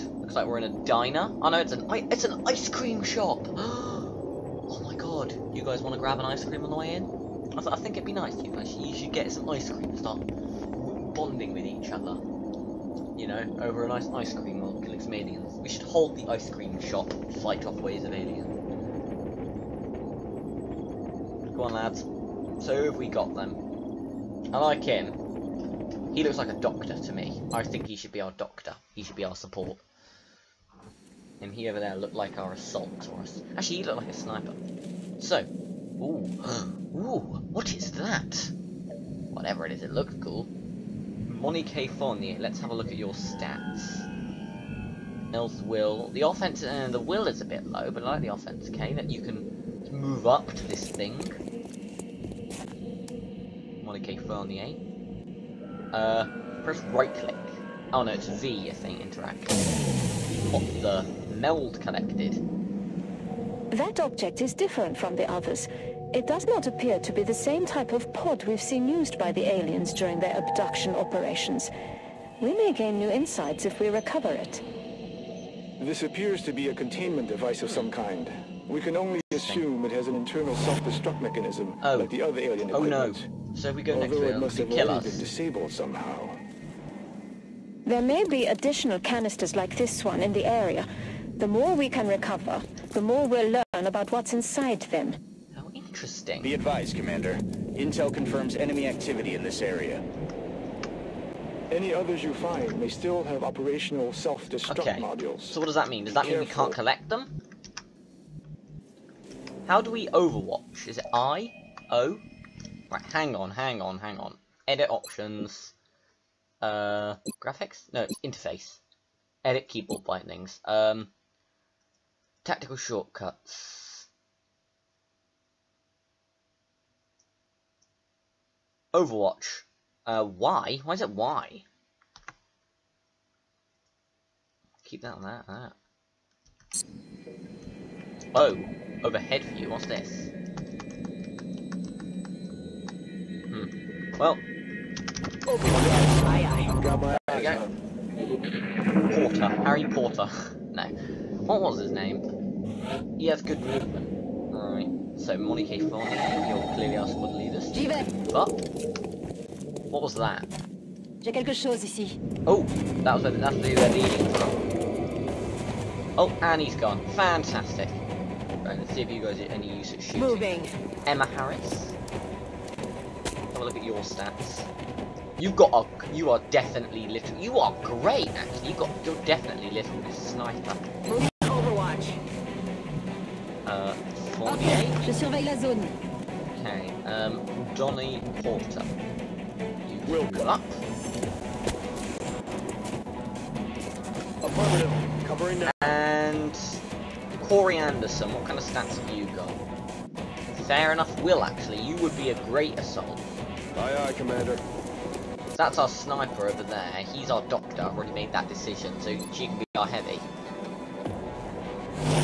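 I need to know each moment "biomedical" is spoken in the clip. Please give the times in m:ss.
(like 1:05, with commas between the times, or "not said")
not said.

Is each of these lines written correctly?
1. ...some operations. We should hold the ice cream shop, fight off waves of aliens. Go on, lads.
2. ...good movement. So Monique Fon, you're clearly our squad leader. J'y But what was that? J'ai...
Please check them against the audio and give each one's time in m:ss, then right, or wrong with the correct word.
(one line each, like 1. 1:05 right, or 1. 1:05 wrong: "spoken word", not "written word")
1. 0:15 wrong: "aliens", not "operations"
2. 2:33 right.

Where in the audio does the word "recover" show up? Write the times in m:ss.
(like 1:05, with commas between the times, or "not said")
1:13, 1:32.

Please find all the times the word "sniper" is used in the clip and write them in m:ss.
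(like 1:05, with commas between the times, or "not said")
0:34, 3:00, 3:25.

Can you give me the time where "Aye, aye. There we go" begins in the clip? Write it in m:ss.
2:26.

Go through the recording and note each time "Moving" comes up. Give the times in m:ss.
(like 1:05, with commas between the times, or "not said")
2:50, 3:01.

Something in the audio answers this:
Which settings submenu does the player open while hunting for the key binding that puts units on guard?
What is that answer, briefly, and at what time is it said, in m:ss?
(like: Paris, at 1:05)
Interface, at 1:58.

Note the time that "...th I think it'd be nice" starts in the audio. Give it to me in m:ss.
0:07.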